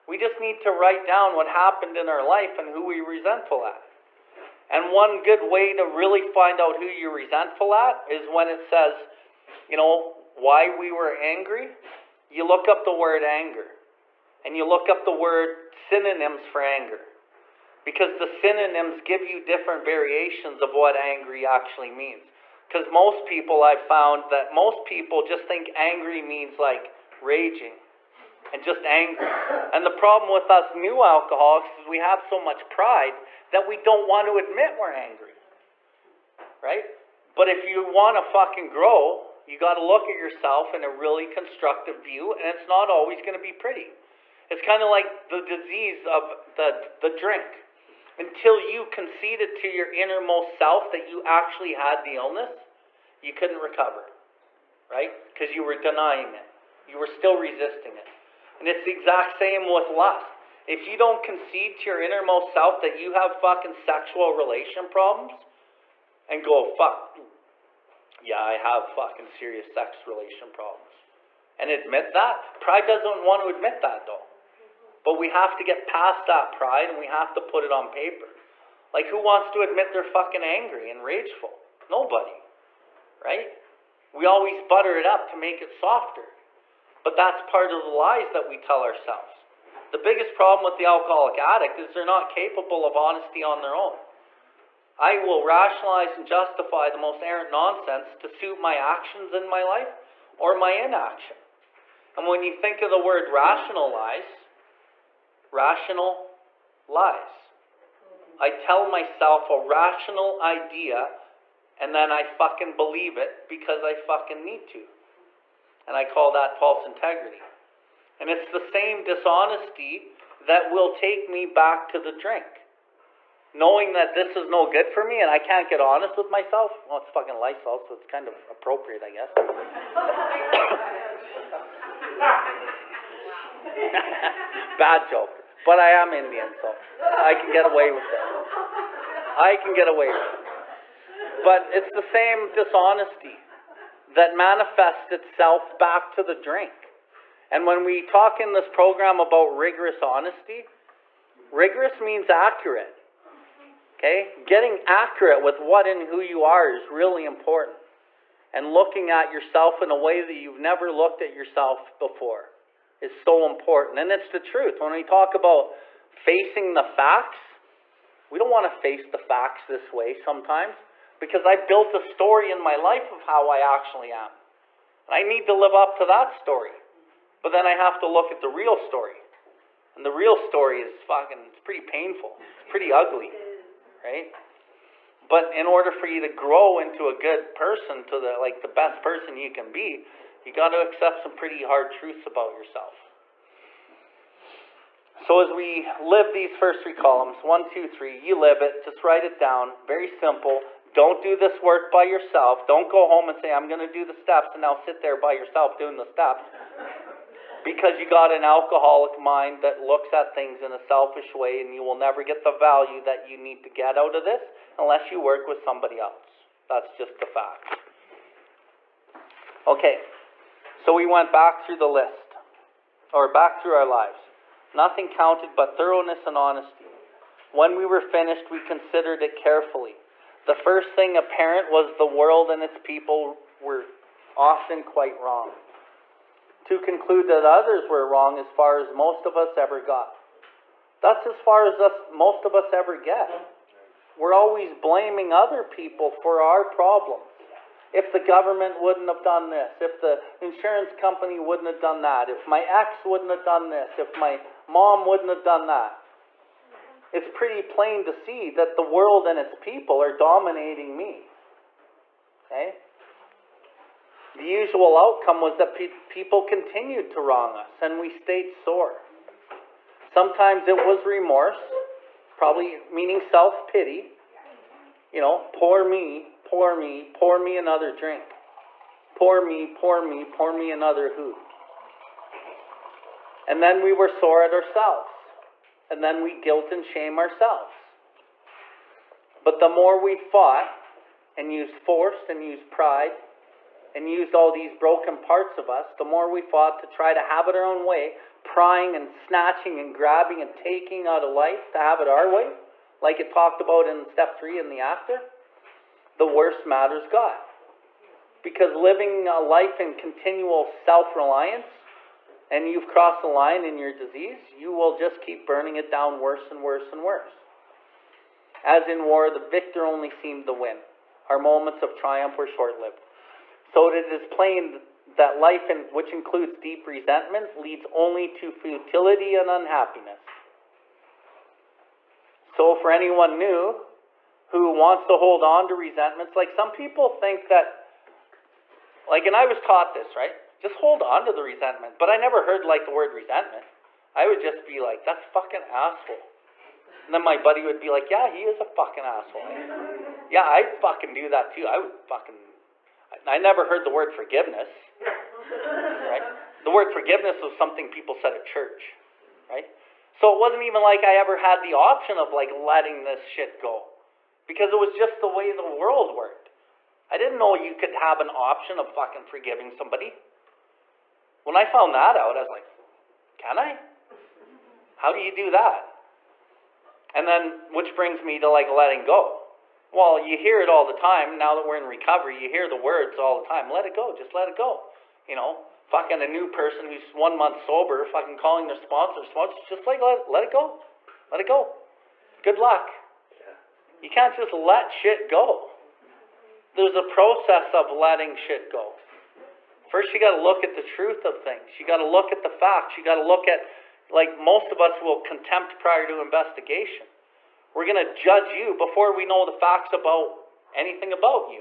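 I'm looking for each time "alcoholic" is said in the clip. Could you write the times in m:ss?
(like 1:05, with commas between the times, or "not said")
0:31, 1:30, 3:28.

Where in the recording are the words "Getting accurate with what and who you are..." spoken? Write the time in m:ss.
2:34.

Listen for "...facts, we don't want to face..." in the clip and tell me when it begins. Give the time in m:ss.
2:46.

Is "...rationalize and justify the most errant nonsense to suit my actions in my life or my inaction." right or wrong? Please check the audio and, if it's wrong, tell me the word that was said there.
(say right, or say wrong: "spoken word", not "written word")
right.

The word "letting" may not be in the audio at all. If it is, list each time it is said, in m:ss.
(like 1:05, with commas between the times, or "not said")
6:02, 6:18, 6:37.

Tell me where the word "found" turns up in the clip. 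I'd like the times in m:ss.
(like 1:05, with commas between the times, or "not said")
0:23, 6:11.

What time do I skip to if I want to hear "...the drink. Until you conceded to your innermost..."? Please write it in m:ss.
0:46.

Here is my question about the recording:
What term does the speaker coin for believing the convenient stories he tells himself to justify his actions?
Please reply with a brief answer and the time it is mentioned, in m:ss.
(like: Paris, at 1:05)
false integrity, at 1:56.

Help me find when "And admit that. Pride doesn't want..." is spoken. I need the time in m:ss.
1:11.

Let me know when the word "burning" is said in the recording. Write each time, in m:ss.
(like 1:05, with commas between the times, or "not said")
5:15.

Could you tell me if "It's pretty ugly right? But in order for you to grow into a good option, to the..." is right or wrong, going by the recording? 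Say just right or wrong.
wrong.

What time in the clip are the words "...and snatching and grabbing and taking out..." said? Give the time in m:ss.
4:58.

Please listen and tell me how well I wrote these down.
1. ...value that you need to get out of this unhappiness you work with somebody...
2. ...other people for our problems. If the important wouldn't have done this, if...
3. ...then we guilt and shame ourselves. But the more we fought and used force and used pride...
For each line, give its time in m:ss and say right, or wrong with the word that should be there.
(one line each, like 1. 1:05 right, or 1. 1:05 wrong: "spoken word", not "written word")
1. 3:32 wrong: "unless", not "unhappiness"
2. 4:05 wrong: "government", not "important"
3. 4:46 right.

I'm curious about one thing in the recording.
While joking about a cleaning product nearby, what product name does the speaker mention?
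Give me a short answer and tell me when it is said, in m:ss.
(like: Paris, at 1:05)
Lysol, at 2:07.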